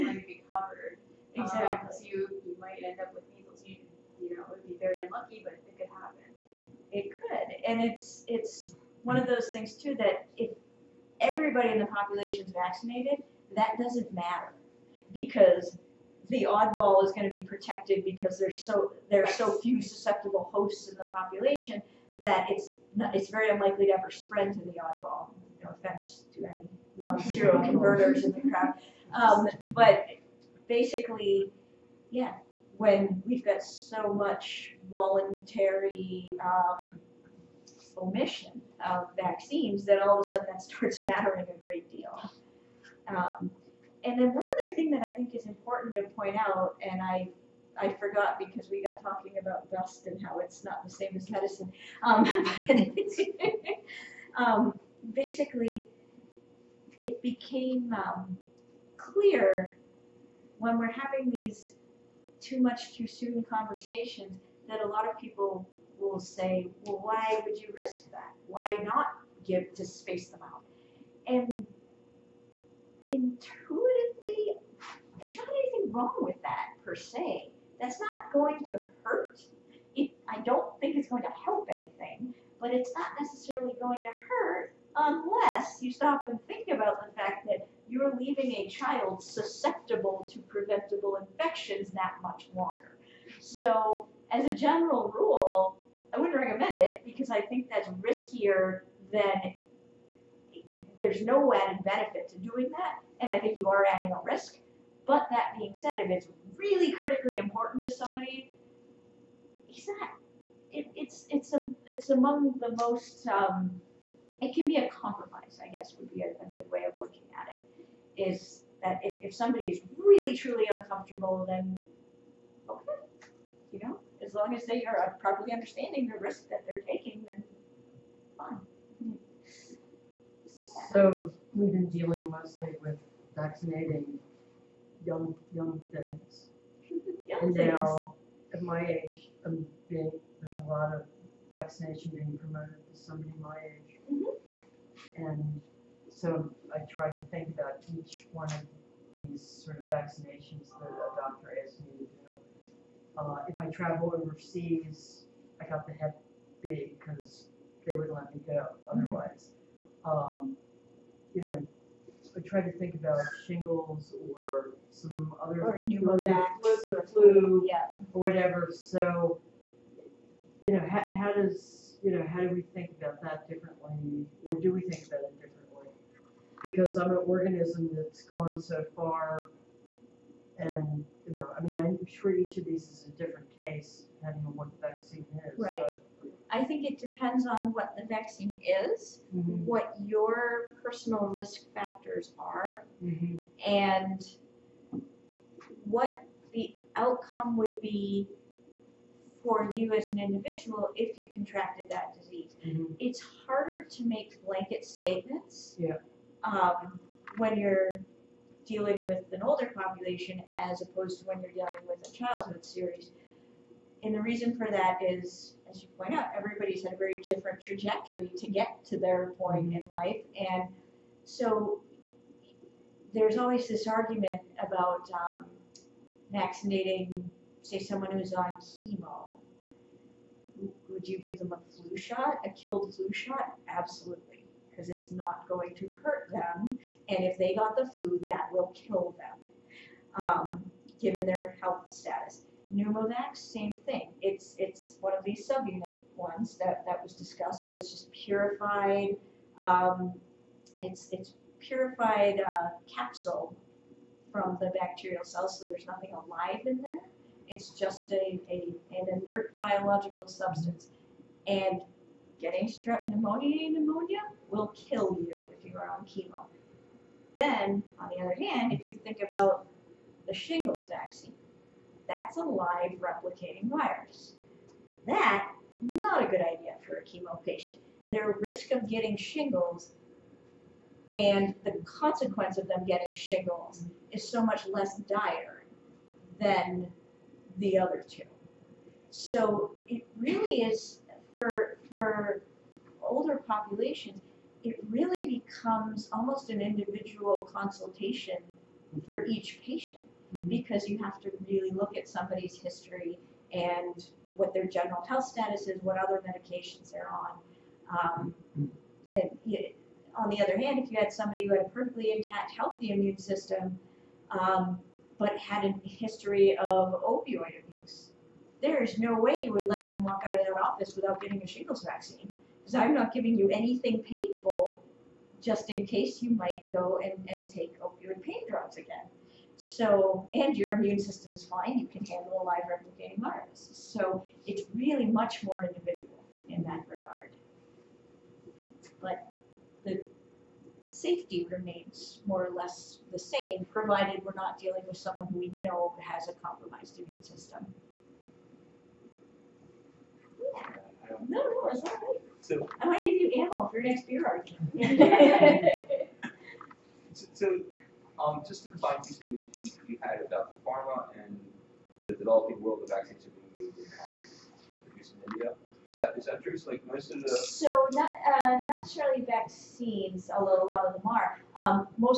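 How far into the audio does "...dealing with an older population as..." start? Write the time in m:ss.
3:28.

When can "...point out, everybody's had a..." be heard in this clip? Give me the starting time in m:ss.
3:35.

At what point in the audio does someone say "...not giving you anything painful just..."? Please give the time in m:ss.
5:22.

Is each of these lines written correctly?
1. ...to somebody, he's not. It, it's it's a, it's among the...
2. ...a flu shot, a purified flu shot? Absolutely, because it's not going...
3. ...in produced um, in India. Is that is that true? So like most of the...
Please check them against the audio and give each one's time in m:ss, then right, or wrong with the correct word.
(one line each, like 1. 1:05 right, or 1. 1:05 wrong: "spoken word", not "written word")
1. 1:47 right
2. 3:51 wrong: "killed", not "purified"
3. 6:03 right.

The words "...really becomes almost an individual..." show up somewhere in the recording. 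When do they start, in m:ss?
4:54.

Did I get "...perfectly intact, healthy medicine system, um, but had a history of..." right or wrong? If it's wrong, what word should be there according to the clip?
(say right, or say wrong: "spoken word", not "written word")
wrong: "immune", not "medicine".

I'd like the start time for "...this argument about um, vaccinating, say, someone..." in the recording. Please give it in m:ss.
3:43.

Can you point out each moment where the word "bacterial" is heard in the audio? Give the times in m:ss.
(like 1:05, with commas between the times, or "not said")
4:14.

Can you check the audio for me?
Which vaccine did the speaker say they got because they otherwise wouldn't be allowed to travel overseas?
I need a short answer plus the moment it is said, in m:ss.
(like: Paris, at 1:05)
Hep B, at 2:35.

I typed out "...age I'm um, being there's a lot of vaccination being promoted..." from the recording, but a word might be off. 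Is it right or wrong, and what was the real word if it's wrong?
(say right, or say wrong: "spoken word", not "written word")
right.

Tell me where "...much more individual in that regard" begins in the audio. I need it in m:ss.
5:35.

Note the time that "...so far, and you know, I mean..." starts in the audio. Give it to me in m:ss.
2:58.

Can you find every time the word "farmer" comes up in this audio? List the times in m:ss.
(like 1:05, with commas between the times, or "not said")
not said.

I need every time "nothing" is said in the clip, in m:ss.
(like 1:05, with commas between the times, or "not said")
4:15.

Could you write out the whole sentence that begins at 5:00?
because you have to really look at somebody's history and what their general health status is, what other medications they're on.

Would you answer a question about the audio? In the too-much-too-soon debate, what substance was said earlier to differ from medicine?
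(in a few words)
Dust.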